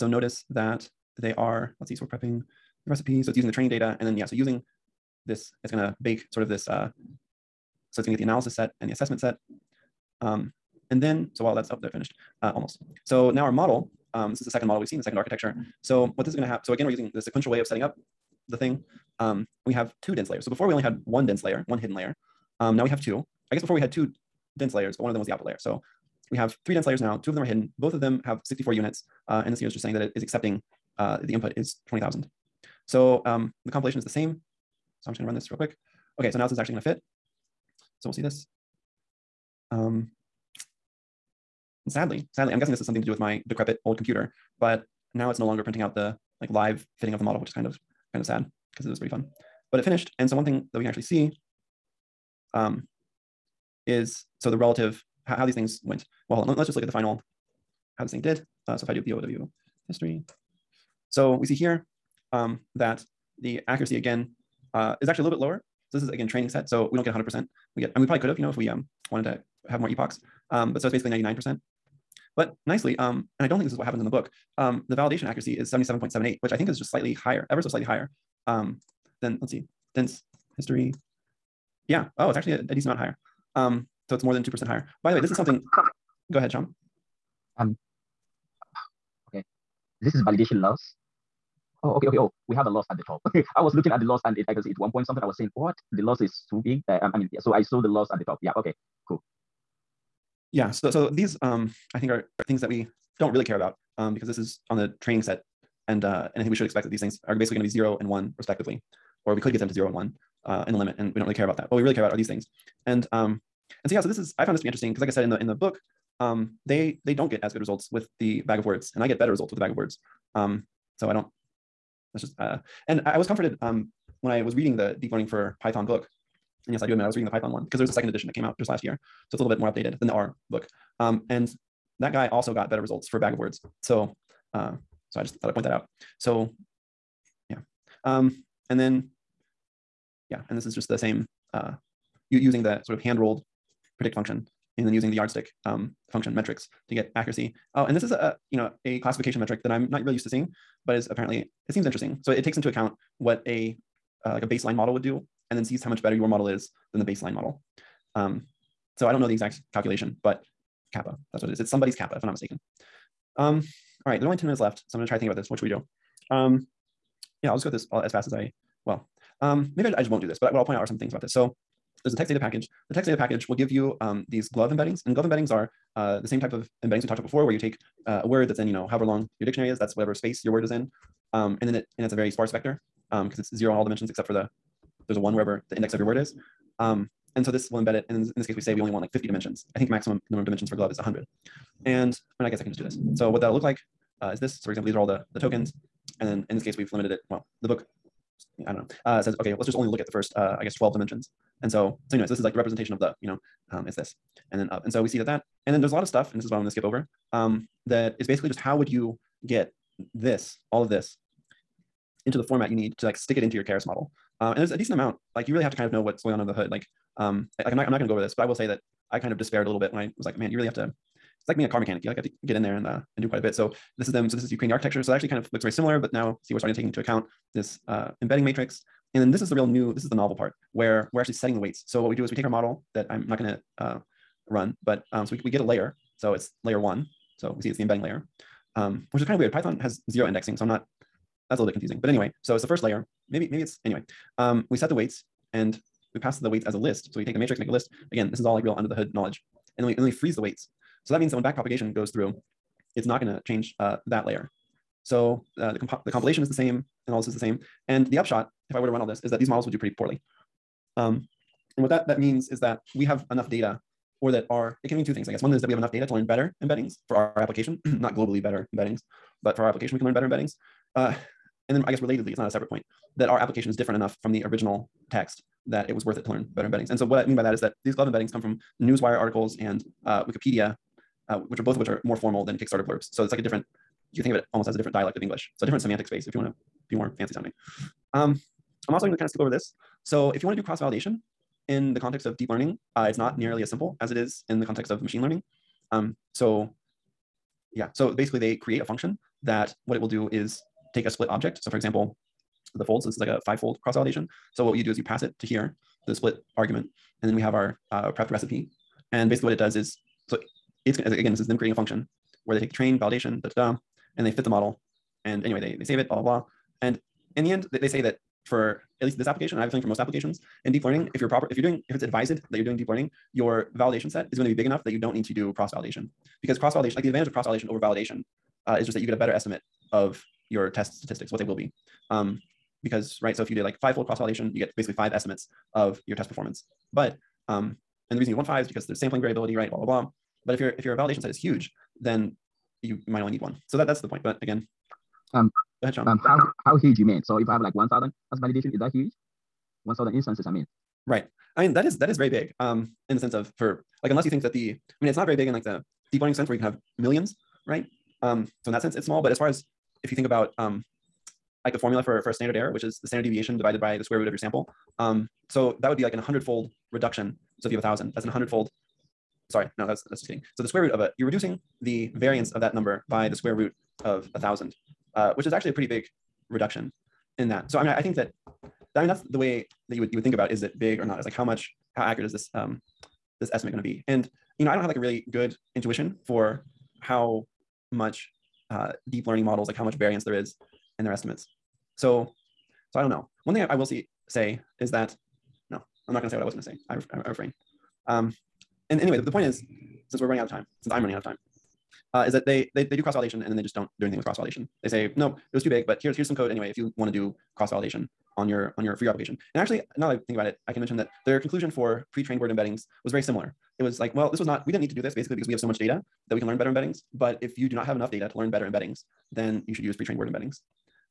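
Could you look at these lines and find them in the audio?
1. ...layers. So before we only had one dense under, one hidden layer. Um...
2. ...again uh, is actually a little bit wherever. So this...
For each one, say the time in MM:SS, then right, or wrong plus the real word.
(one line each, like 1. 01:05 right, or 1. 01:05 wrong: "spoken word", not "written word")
1. 00:20 wrong: "layer", not "under"
2. 01:03 wrong: "lower", not "wherever".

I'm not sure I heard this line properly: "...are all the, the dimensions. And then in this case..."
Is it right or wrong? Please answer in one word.
wrong.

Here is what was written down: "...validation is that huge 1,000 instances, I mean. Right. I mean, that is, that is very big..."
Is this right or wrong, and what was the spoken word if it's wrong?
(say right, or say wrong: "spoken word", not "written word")
right.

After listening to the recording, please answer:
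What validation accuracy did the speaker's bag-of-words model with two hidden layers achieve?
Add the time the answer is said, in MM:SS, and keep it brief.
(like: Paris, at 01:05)
77.78, at 01:15.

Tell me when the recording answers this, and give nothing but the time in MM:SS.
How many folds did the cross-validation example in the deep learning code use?
05:03.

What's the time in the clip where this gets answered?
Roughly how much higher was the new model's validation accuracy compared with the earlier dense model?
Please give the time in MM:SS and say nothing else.
01:24.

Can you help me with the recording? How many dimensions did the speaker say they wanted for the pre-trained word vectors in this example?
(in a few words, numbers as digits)
50.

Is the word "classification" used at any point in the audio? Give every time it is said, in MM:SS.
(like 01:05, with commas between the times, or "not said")
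02:28.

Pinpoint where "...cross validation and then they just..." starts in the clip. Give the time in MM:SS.
06:43.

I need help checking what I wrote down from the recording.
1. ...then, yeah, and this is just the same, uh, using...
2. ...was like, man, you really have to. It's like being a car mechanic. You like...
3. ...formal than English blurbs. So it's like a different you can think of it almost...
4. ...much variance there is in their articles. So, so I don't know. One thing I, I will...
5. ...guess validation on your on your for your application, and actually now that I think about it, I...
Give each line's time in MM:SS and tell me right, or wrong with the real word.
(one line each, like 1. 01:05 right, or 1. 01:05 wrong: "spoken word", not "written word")
1. 02:18 right
2. 03:40 right
3. 04:42 wrong: "Kickstarter", not "English"
4. 06:29 wrong: "estimates", not "articles"
5. 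06:47 wrong: "cross", not "guess".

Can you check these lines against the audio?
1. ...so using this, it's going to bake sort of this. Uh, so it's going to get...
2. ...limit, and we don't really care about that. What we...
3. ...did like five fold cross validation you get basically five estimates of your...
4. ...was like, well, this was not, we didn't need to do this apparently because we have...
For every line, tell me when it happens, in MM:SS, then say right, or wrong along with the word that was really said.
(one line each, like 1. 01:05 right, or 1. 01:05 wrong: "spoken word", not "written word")
1. 00:04 right
2. 01:50 right
3. 05:33 right
4. 06:53 wrong: "basically", not "apparently".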